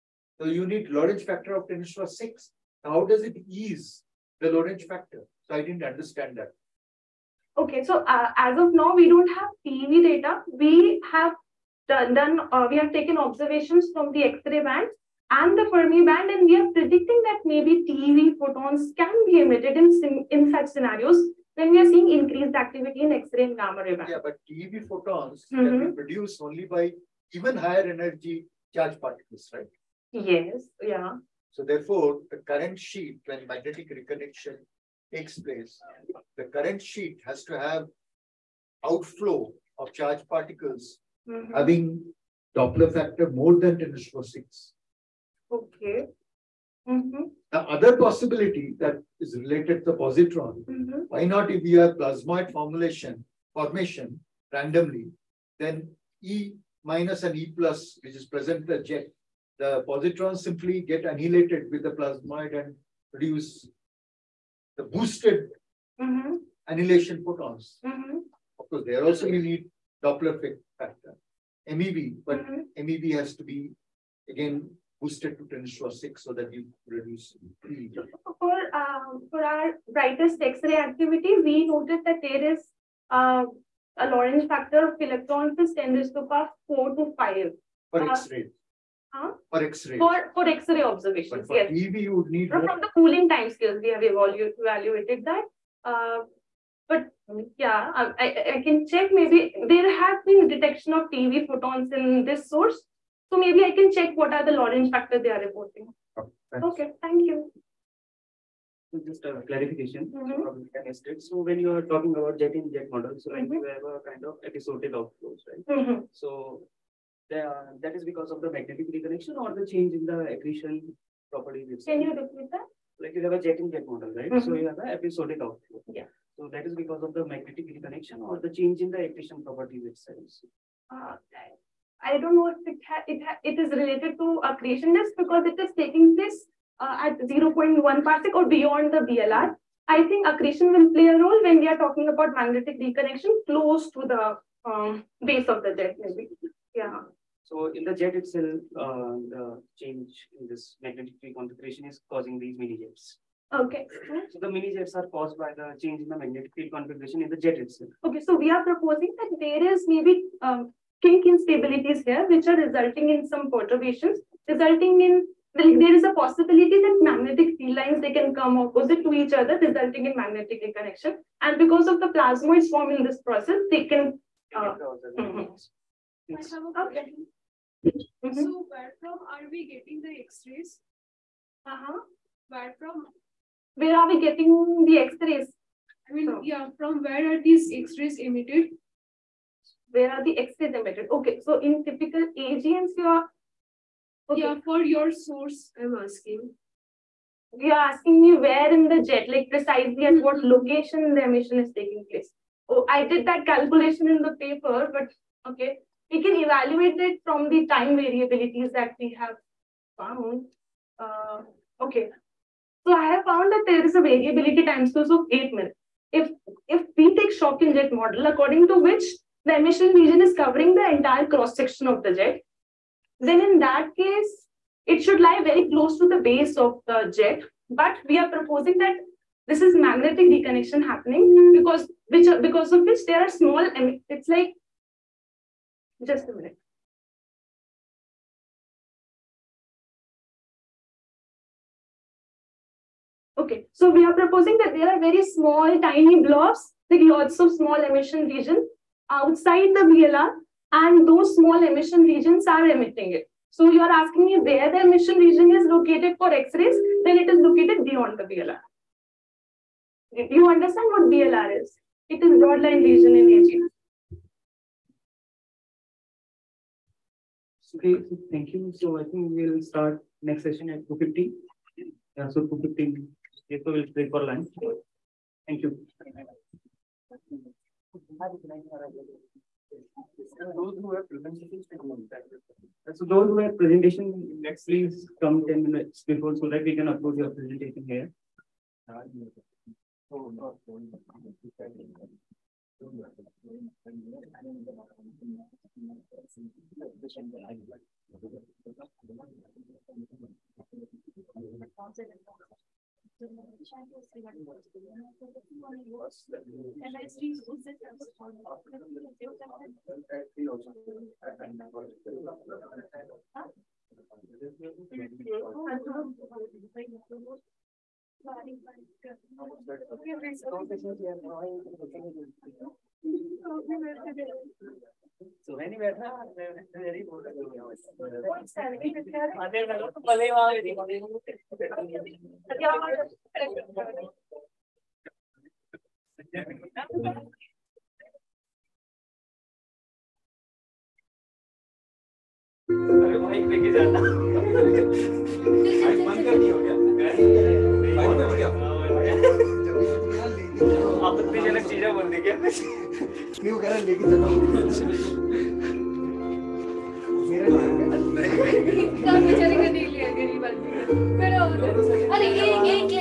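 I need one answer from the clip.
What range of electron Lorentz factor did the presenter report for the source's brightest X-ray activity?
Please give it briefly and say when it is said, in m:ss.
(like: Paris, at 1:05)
10^4 to 10^5, at 1:25.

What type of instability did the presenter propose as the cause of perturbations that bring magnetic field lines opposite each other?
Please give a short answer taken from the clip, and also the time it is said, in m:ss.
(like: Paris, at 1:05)
kink instabilities, at 2:41.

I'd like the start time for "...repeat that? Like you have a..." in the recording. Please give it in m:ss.
2:02.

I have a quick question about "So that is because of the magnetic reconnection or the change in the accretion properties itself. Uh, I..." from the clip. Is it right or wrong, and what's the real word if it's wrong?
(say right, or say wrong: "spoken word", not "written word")
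right.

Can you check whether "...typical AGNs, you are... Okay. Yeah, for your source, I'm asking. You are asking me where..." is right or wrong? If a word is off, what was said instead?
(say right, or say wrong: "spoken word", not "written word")
right.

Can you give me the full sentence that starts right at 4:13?
So you are asking me where the emission region is located for X-rays, then it is located beyond the BLR.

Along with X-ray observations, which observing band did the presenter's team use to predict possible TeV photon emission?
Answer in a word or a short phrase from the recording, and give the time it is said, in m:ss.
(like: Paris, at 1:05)
Fermi band, at 0:15.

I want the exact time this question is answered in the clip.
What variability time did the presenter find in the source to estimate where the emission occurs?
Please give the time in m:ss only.
3:35.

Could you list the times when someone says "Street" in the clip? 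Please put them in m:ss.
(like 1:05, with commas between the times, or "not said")
not said.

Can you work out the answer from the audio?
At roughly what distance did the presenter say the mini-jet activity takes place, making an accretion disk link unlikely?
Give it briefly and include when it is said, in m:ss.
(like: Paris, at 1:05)
0.1 parsec, at 2:17.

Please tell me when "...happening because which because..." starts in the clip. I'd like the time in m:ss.
3:50.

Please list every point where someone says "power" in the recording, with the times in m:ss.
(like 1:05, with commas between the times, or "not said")
0:01, 1:26.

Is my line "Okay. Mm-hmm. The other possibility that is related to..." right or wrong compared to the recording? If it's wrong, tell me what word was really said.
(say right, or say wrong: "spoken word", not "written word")
right.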